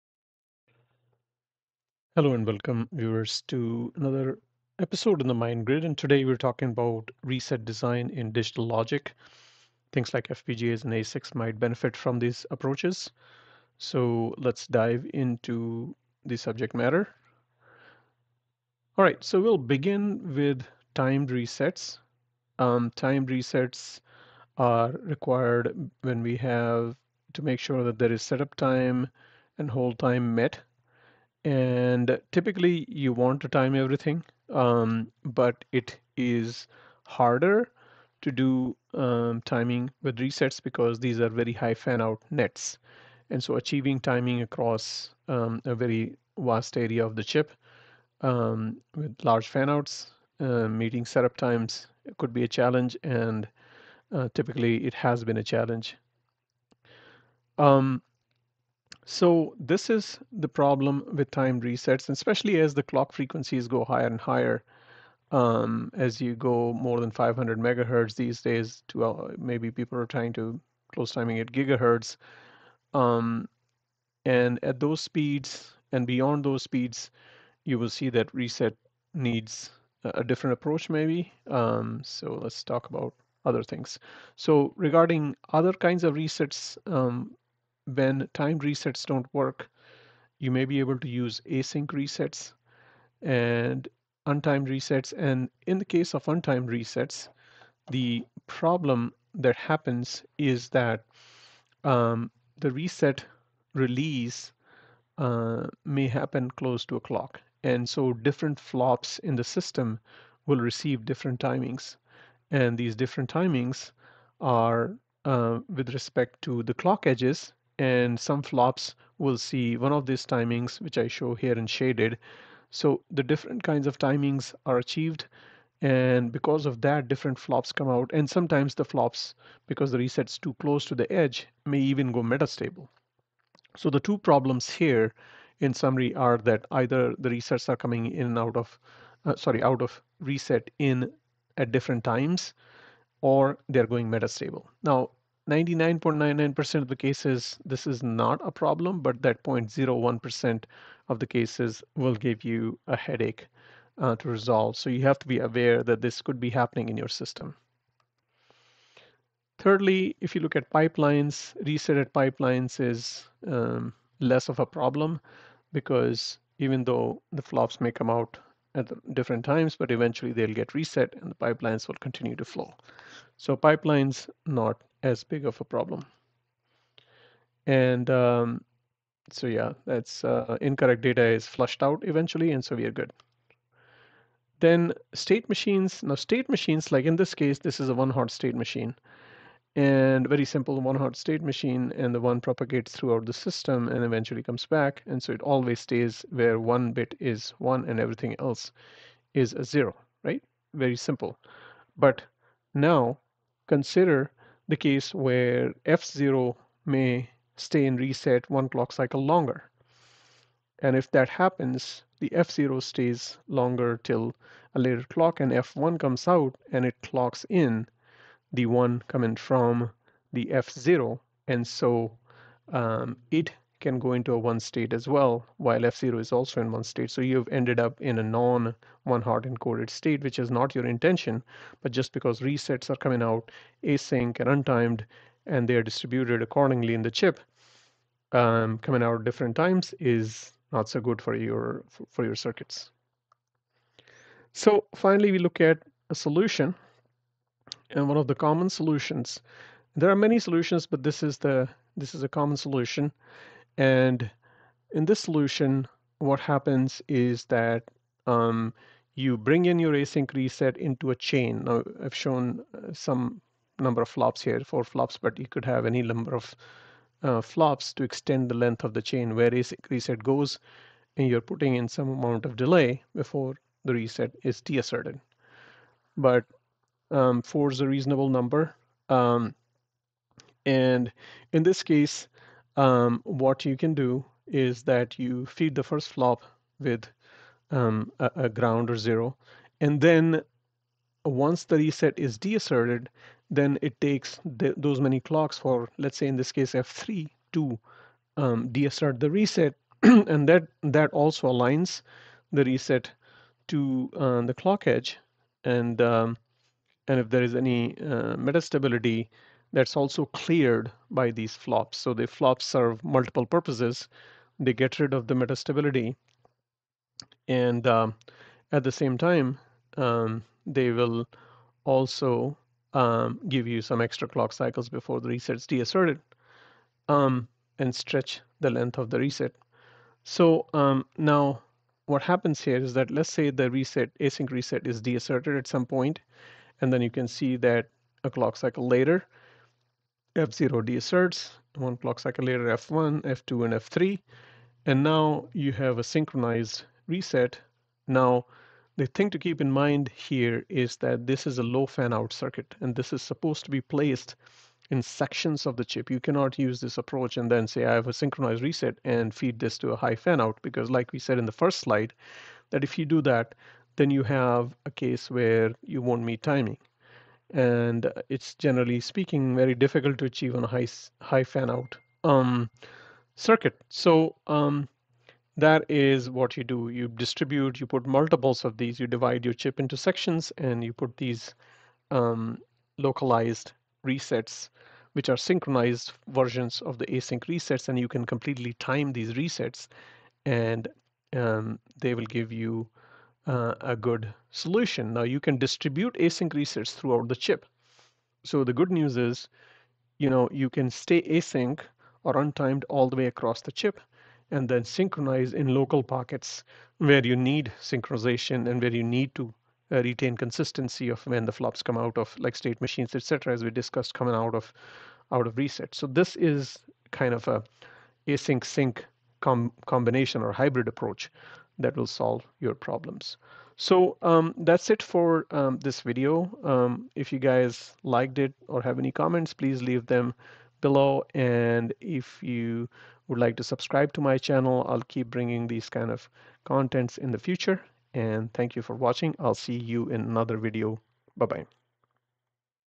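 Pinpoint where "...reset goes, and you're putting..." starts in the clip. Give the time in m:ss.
4:29.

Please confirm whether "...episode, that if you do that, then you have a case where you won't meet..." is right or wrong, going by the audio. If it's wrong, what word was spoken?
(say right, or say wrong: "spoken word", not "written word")
wrong: "slide", not "episode".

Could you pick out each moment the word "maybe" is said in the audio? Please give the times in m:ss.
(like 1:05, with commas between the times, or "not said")
1:09, 1:20.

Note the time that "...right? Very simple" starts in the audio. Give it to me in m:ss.
3:20.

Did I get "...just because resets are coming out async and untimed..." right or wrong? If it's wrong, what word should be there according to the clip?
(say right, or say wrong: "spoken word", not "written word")
right.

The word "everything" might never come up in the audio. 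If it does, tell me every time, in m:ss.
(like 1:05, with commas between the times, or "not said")
0:33, 3:17.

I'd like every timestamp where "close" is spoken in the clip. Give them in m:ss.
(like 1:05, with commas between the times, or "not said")
1:10, 1:46, 2:10.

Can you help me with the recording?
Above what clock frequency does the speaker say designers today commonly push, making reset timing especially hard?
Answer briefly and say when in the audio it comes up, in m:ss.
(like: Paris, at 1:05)
500 megahertz, at 1:07.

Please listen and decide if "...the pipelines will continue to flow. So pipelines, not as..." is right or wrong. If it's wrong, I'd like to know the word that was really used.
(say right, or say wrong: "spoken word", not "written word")
right.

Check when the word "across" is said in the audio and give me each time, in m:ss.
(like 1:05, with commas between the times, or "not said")
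0:44, 6:43.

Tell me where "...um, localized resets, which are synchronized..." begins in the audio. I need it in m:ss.
6:22.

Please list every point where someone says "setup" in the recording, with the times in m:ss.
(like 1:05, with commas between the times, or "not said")
0:28, 0:51.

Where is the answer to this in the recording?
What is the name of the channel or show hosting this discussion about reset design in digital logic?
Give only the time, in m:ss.
0:05.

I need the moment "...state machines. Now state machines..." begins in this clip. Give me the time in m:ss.
3:05.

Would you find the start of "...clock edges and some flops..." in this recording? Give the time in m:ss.
1:56.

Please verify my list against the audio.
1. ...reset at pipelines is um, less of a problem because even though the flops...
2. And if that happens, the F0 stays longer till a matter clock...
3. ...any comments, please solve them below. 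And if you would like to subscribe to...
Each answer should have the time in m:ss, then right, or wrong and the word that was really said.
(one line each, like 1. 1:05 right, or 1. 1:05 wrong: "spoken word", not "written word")
1. 2:41 right
2. 3:30 wrong: "later", not "matter"
3. 7:08 wrong: "leave", not "solve".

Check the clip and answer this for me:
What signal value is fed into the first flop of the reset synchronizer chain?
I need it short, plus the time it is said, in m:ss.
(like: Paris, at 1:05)
Ground or zero, at 4:48.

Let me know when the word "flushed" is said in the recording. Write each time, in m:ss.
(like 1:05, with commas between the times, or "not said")
3:01.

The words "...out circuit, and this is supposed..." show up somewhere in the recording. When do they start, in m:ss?
5:52.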